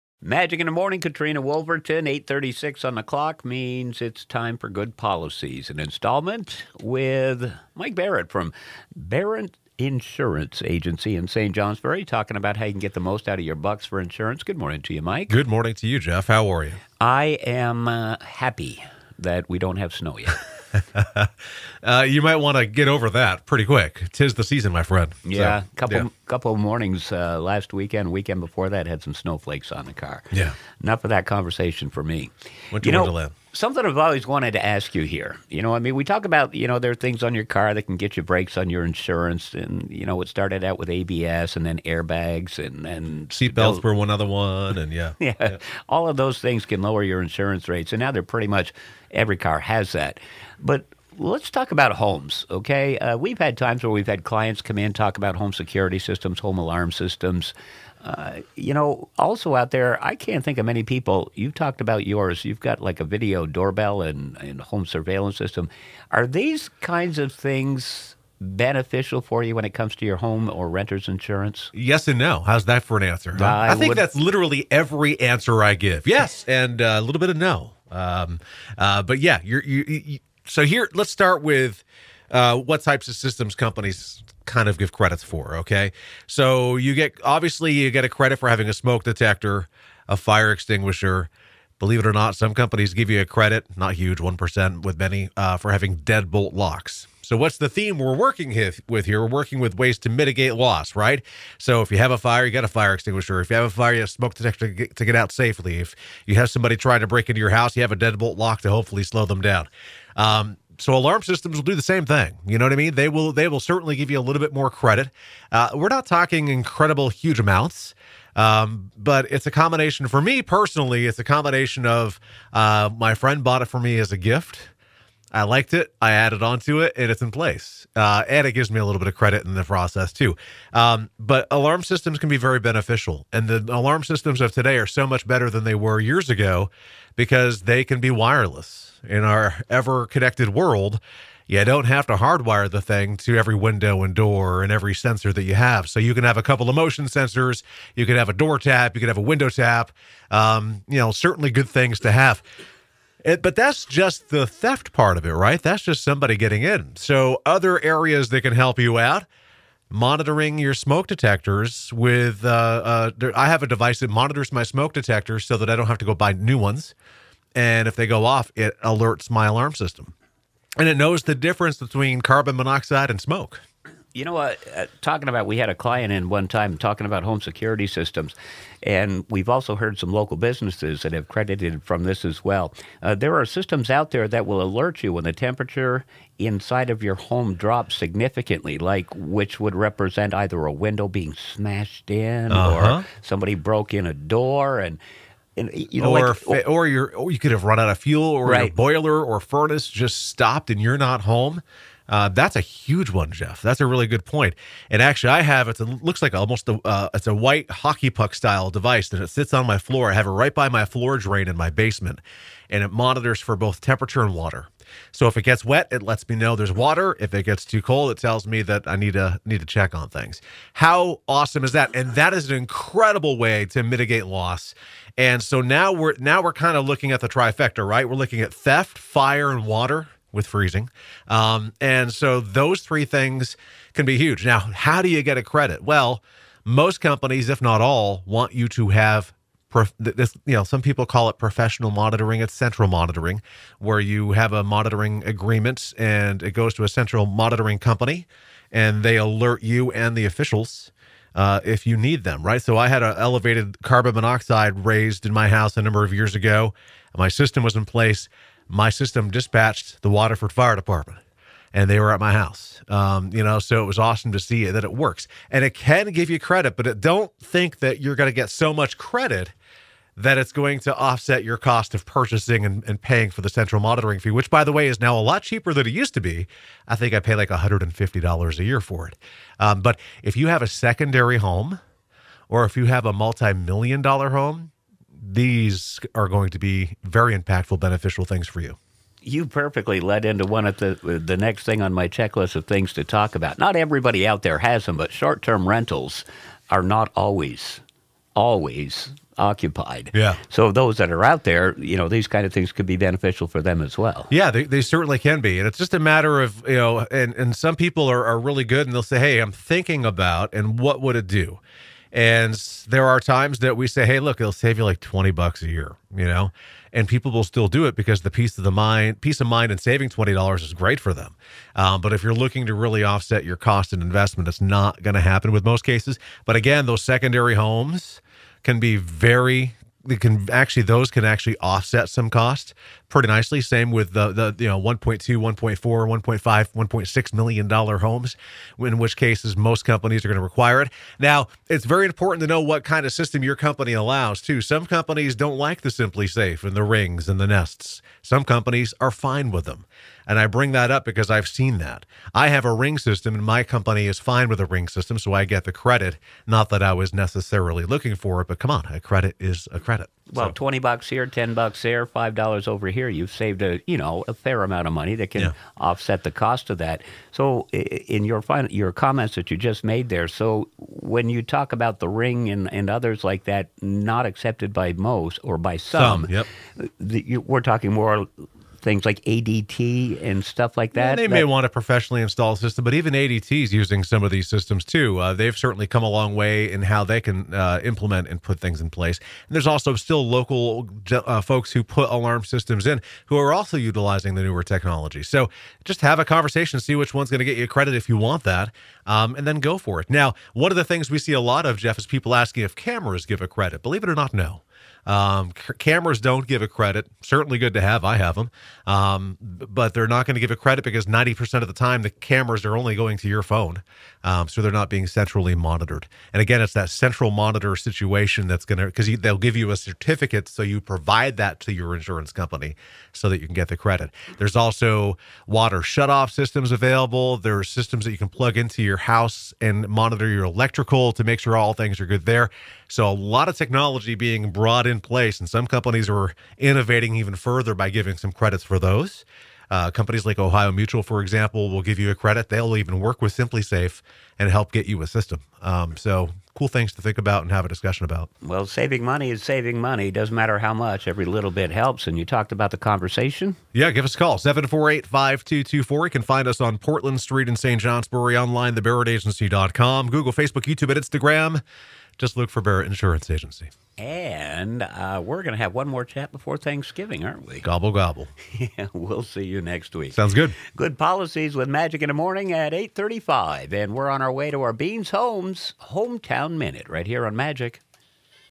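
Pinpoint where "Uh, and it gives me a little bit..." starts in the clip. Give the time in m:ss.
2:07.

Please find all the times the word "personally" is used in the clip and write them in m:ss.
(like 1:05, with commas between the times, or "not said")
2:00.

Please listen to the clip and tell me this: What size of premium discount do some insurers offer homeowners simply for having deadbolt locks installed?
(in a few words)
1 percent.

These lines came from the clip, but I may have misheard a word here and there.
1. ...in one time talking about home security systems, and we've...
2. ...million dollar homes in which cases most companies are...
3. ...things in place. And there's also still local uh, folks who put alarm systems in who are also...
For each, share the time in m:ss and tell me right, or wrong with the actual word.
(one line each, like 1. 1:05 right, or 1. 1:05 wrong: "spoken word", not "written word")
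1. 2:56 right
2. 5:37 right
3. 6:28 right.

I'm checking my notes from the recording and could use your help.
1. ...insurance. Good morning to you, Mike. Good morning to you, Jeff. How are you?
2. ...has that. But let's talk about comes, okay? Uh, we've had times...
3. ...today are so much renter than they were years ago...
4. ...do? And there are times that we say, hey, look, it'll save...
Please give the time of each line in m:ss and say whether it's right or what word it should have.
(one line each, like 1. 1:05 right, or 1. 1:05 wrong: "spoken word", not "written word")
1. 0:13 right
2. 0:49 wrong: "homes", not "comes"
3. 2:14 wrong: "better", not "renter"
4. 5:11 right.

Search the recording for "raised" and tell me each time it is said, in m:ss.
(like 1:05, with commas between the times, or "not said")
4:14.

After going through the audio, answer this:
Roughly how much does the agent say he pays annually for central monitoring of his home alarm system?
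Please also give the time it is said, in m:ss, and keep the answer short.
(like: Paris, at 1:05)
$150, at 4:37.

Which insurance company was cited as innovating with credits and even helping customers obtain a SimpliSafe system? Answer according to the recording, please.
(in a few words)
Ohio Mutual.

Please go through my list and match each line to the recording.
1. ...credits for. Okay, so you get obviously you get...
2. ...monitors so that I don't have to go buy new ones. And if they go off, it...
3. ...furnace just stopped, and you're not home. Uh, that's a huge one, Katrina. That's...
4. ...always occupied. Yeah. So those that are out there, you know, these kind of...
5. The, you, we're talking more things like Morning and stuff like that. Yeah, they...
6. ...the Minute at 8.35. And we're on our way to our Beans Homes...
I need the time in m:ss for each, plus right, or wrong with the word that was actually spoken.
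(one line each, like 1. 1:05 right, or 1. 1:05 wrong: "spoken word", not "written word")
1. 1:24 right
2. 2:44 wrong: "detectors", not "monitors"
3. 3:19 wrong: "Jeff", not "Katrina"
4. 4:58 right
5. 6:16 wrong: "ADT", not "Morning"
6. 7:52 wrong: "Morning", not "Minute".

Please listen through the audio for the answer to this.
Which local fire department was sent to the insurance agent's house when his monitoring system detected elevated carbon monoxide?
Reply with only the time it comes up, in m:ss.
4:20.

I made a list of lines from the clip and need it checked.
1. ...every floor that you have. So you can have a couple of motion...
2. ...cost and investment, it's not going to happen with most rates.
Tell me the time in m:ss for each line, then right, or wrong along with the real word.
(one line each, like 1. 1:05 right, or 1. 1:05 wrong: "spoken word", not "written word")
1. 2:24 wrong: "sensor", not "floor"
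2. 5:23 wrong: "cases", not "rates".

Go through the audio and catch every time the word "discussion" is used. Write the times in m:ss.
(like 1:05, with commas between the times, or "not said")
7:27.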